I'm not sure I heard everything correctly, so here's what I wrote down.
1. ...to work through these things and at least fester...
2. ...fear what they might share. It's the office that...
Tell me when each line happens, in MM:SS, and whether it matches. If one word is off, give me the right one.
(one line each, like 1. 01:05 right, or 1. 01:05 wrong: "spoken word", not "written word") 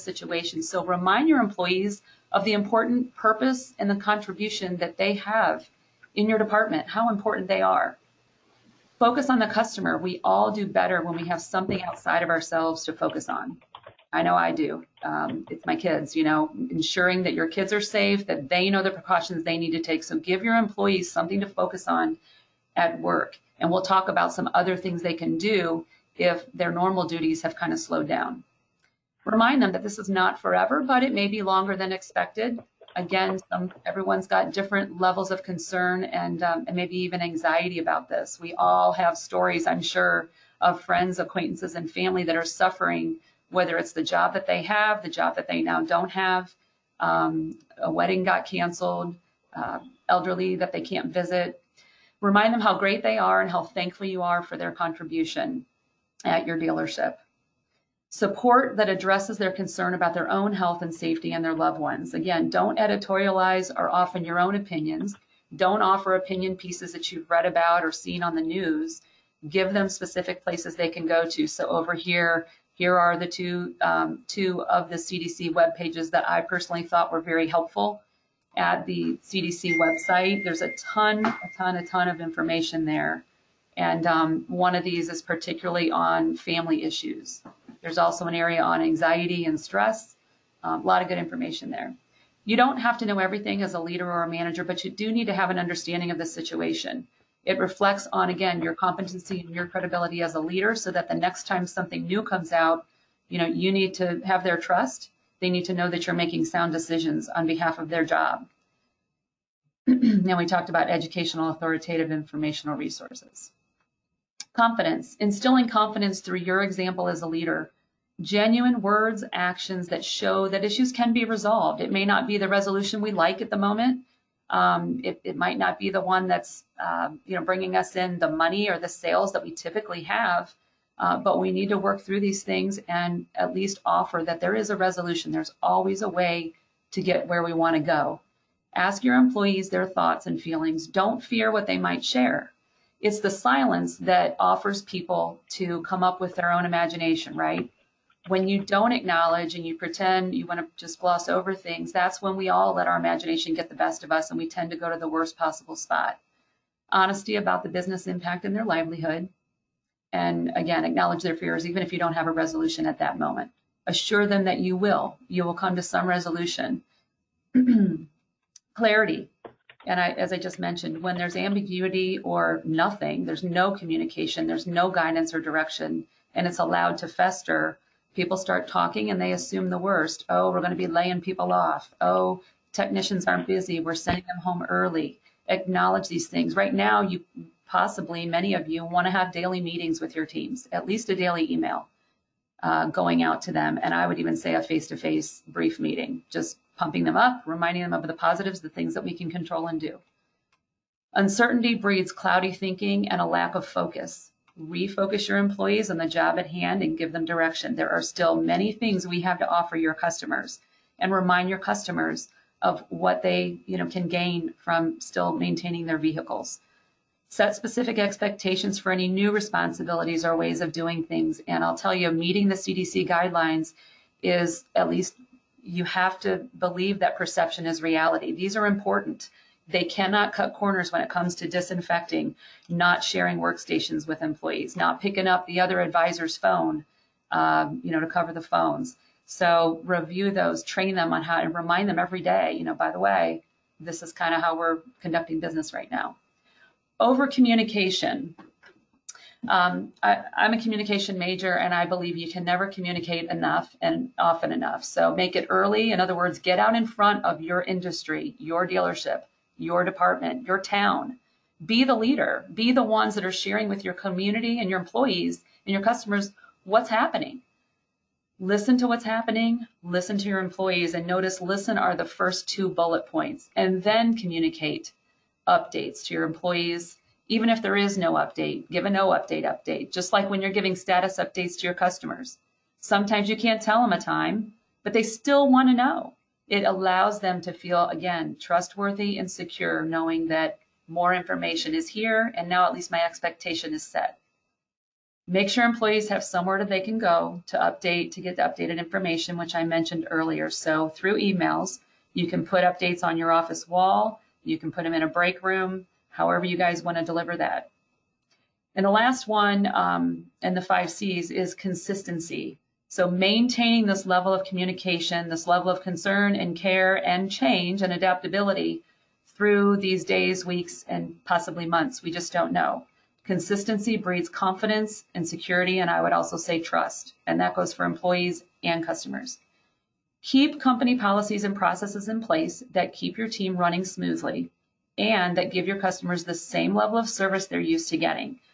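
1. 02:11 wrong: "offer", not "fester"
2. 02:21 wrong: "silence", not "office".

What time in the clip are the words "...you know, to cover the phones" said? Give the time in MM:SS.
03:57.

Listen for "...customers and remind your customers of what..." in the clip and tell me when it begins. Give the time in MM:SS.
03:29.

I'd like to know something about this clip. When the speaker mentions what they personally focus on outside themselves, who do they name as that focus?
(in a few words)
My kids.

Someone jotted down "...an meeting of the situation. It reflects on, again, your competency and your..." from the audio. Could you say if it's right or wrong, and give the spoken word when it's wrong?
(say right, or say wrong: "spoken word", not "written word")
wrong: "understanding", not "meeting".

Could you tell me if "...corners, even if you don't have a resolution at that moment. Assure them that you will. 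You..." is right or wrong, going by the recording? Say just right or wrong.
wrong.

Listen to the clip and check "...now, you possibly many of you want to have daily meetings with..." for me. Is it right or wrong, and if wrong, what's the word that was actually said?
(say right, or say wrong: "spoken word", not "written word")
right.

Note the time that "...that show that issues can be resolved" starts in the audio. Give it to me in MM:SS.
01:59.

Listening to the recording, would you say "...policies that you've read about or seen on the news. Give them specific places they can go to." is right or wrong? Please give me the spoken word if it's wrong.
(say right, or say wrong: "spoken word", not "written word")
wrong: "pieces", not "policies".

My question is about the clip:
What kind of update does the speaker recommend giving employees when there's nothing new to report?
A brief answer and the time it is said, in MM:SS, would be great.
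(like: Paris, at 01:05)
A no update update, at 04:38.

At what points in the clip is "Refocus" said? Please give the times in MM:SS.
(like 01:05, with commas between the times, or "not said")
03:24.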